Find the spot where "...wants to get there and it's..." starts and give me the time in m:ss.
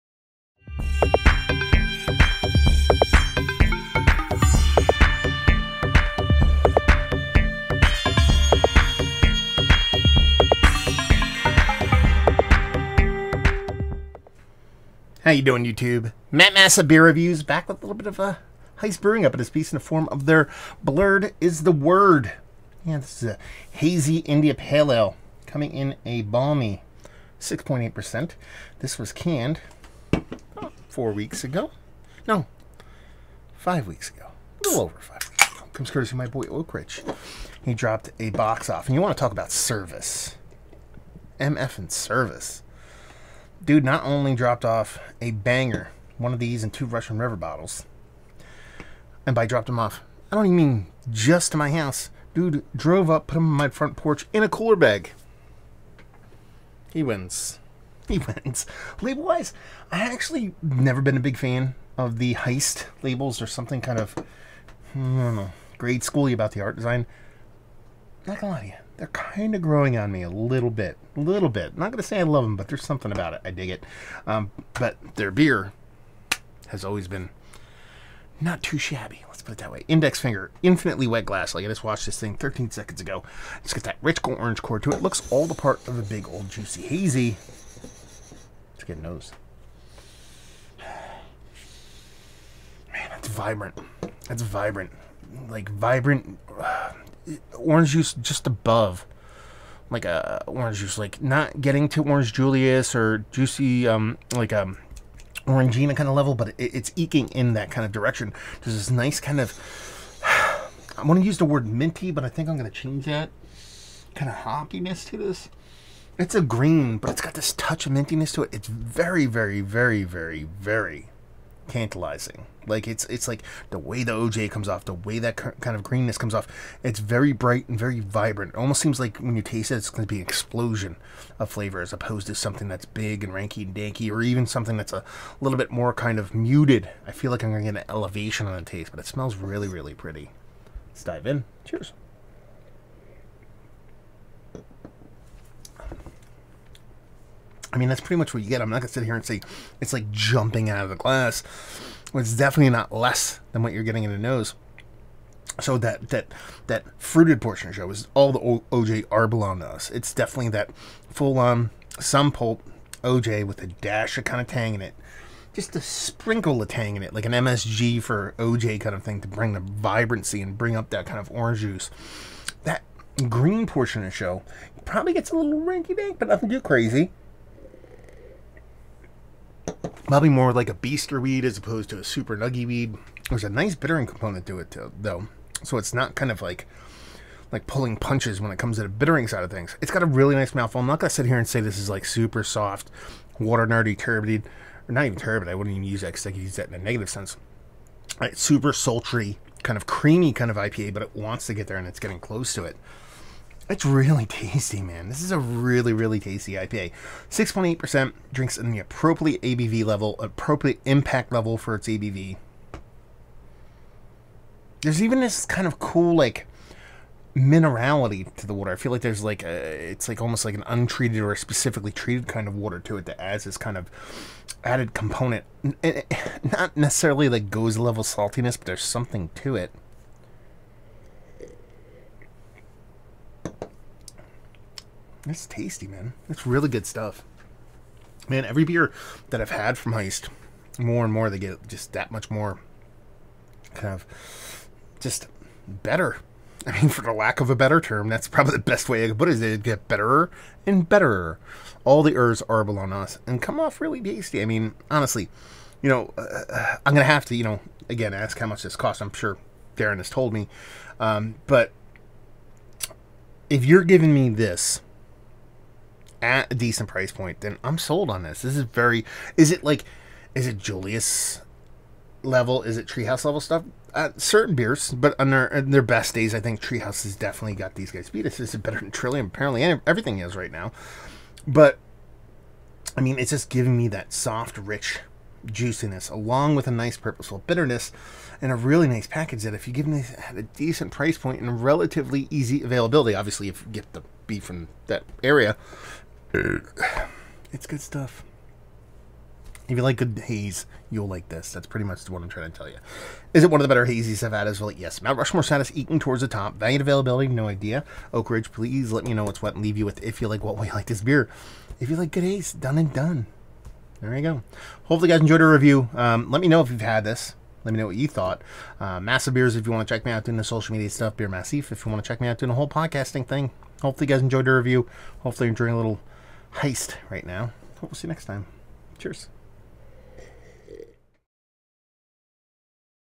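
3:21.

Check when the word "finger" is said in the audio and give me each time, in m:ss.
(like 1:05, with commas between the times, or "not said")
1:20.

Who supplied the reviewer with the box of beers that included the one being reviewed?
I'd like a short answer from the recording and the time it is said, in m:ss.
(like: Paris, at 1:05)
Oakridge, at 0:36.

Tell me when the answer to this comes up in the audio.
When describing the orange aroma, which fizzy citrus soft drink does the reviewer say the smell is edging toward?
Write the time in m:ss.
1:45.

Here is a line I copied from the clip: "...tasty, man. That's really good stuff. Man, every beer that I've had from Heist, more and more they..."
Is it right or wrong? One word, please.
right.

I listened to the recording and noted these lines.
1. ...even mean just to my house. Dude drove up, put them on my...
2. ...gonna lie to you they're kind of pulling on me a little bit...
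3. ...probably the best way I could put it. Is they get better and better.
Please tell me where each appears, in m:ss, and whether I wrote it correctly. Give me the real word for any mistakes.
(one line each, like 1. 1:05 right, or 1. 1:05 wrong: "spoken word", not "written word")
1. 0:50 right
2. 1:08 wrong: "growing", not "pulling"
3. 4:08 right.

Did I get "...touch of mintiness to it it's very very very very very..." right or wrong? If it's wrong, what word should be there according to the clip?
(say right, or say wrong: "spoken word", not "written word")
right.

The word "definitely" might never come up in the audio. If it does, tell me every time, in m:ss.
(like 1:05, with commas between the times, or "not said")
2:32, 2:40, 4:37.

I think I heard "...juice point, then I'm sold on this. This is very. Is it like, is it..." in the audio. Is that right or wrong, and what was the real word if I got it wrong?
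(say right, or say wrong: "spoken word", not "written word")
wrong: "price", not "juice".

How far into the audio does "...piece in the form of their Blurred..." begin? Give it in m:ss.
0:19.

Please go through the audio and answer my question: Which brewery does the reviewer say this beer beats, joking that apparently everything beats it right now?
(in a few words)
Trillium.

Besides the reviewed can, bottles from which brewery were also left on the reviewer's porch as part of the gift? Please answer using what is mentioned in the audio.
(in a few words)
Russian River.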